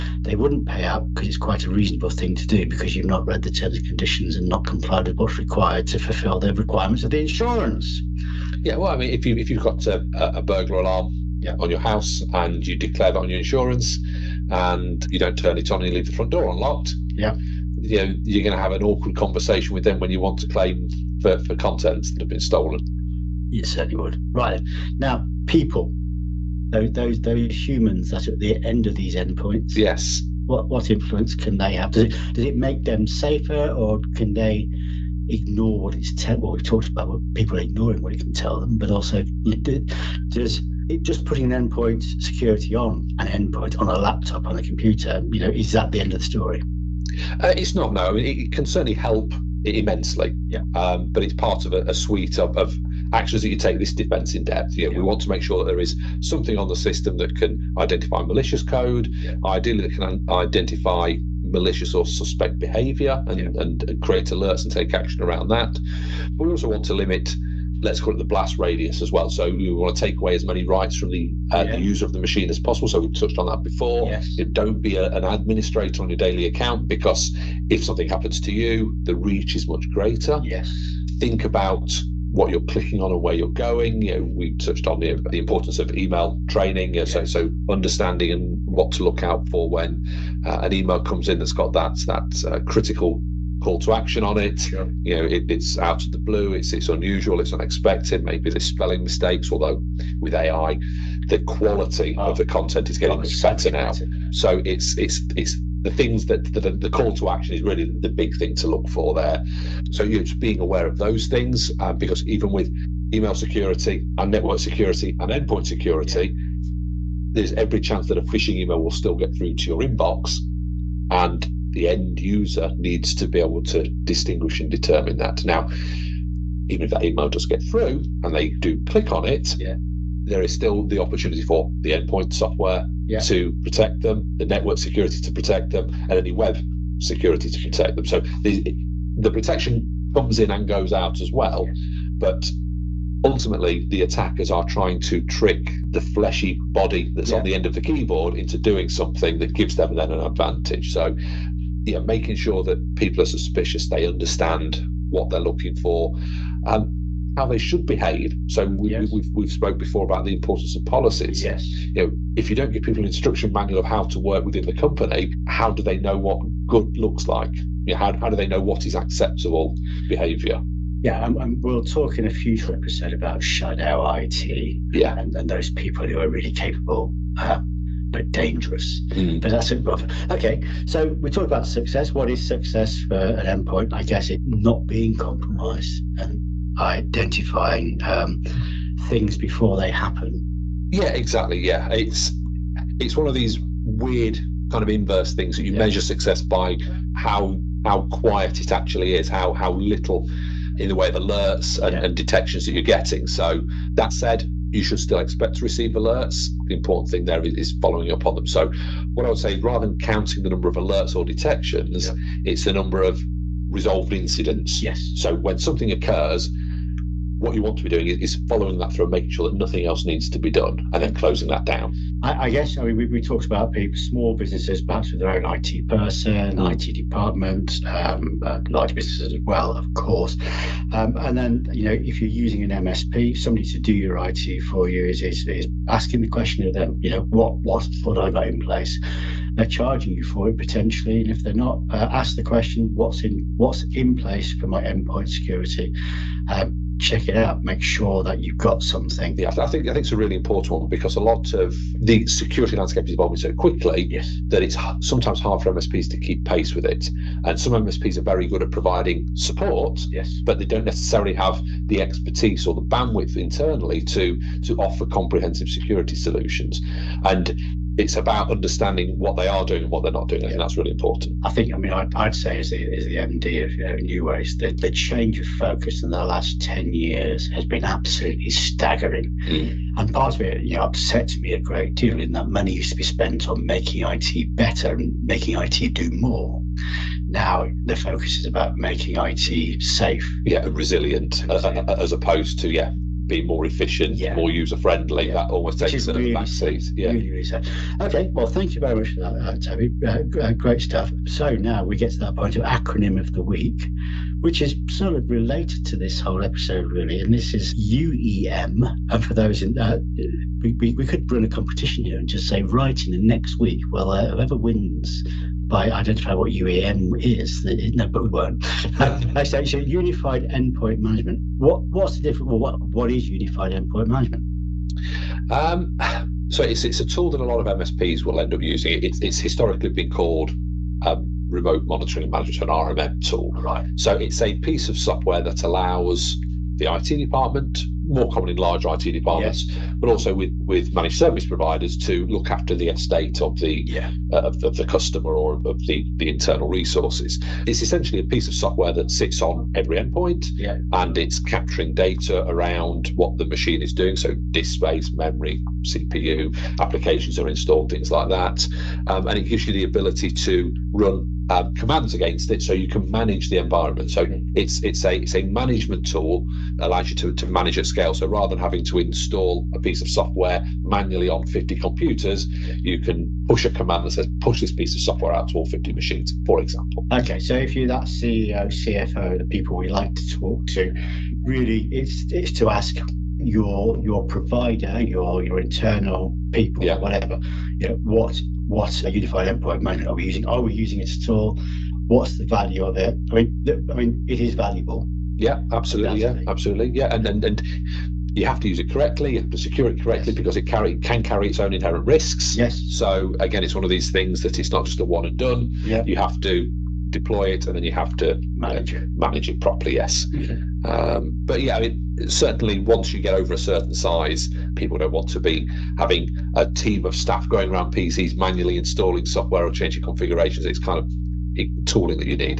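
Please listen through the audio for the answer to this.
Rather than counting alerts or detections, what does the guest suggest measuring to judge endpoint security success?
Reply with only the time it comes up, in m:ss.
3:32.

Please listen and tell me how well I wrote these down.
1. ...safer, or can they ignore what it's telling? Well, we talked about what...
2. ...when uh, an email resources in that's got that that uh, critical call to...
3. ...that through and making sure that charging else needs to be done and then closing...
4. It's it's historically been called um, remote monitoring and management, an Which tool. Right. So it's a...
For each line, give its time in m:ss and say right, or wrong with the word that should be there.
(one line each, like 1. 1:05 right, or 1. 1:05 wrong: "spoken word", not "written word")
1. 0:33 right
2. 1:29 wrong: "comes", not "resources"
3. 3:38 wrong: "nothing", not "charging"
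4. 5:29 wrong: "RMM", not "Which".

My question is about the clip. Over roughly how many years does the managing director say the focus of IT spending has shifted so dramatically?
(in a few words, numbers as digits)
10.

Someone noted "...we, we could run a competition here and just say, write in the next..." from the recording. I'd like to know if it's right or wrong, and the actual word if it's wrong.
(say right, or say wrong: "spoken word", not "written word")
right.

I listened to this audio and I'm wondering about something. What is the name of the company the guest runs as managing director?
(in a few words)
Neuways.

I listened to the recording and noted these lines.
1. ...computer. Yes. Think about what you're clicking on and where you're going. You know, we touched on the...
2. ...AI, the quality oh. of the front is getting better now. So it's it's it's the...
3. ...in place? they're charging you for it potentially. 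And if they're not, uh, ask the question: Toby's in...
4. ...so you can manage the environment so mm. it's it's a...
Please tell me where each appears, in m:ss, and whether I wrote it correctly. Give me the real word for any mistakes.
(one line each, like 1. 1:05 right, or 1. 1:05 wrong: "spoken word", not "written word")
1. 1:19 wrong: "greater", not "computer"
2. 1:40 wrong: "content", not "front"
3. 3:58 wrong: "What", not "Toby"
4. 6:02 right.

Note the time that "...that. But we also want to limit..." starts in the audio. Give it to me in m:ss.
1:05.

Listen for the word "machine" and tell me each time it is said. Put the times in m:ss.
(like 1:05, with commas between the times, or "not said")
1:12, 5:53, 6:15.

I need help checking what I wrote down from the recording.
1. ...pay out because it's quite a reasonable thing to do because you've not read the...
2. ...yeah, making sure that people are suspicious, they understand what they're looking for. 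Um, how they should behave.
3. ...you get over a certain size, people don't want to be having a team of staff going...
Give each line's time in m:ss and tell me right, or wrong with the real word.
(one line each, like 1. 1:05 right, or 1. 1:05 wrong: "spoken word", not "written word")
1. 0:00 right
2. 2:31 right
3. 6:53 right.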